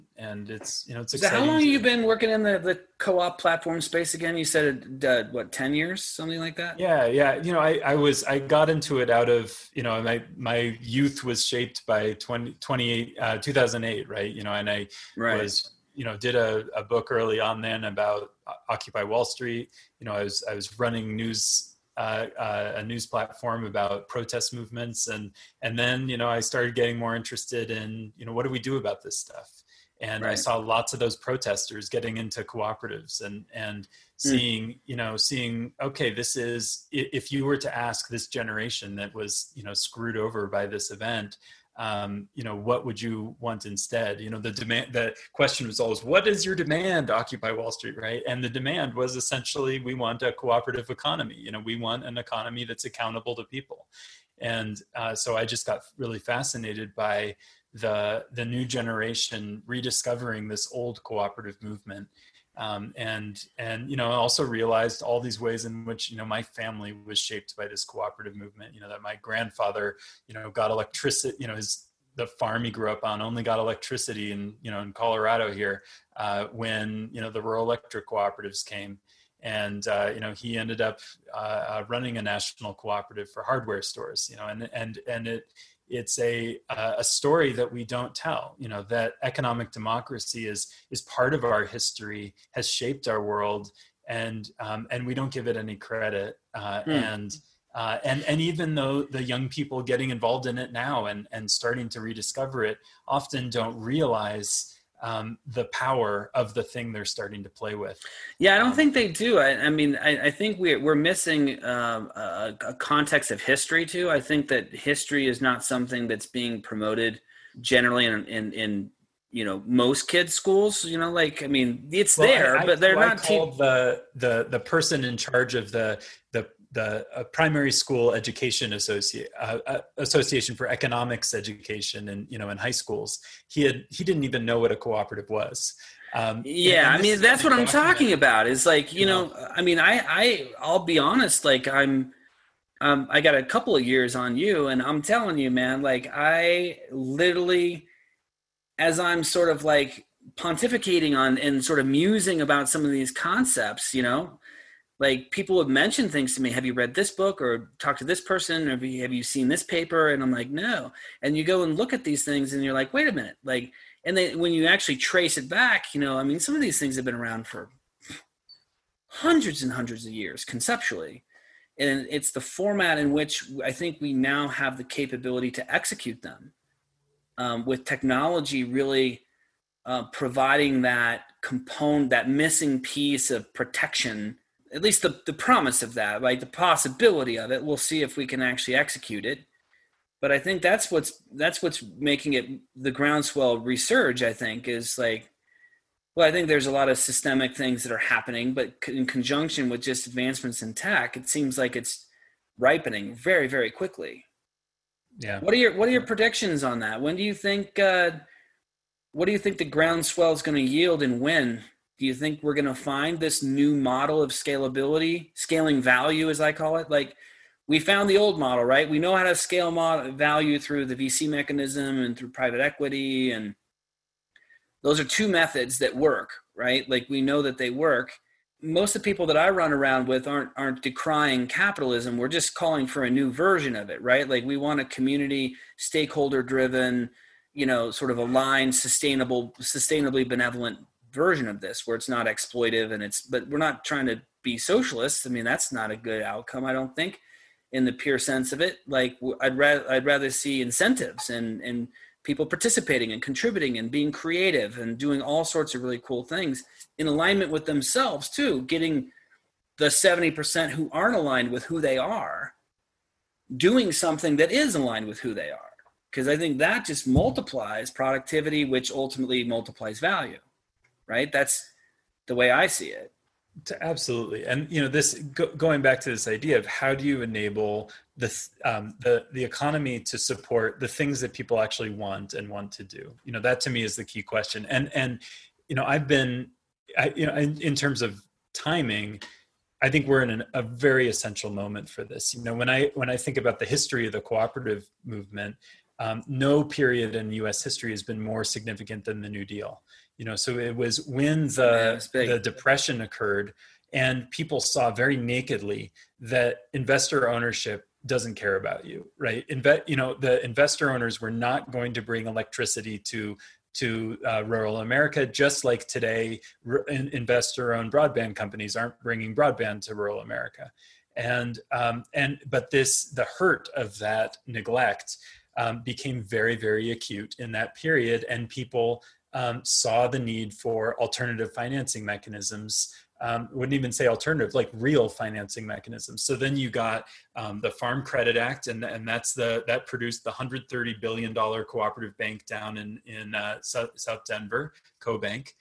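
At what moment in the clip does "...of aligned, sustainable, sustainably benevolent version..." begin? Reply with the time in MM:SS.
03:58.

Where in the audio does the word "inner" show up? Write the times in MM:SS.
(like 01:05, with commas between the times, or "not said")
not said.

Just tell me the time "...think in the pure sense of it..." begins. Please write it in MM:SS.
04:06.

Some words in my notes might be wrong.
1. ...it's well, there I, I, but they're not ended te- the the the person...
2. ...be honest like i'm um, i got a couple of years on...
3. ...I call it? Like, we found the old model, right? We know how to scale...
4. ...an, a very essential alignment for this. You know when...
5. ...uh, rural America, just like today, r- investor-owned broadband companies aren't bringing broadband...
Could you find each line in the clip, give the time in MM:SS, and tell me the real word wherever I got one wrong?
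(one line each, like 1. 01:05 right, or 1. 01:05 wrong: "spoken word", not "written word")
1. 02:01 wrong: "called", not "ended"
2. 02:20 right
3. 03:36 right
4. 04:50 wrong: "moment", not "alignment"
5. 05:14 right.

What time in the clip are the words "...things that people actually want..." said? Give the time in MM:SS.
04:40.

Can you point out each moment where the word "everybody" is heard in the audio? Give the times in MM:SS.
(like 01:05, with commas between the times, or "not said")
not said.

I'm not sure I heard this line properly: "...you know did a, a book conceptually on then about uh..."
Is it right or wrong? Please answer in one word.
wrong.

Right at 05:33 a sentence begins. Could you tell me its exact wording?
Um, wouldn't even say alternative, like real financing mechanisms.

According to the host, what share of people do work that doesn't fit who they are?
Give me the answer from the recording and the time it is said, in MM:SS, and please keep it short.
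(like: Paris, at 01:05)
70%, at 04:19.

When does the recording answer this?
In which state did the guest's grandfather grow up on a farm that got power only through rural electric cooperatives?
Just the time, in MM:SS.
01:14.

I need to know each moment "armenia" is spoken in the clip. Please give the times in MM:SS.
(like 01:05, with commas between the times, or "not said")
not said.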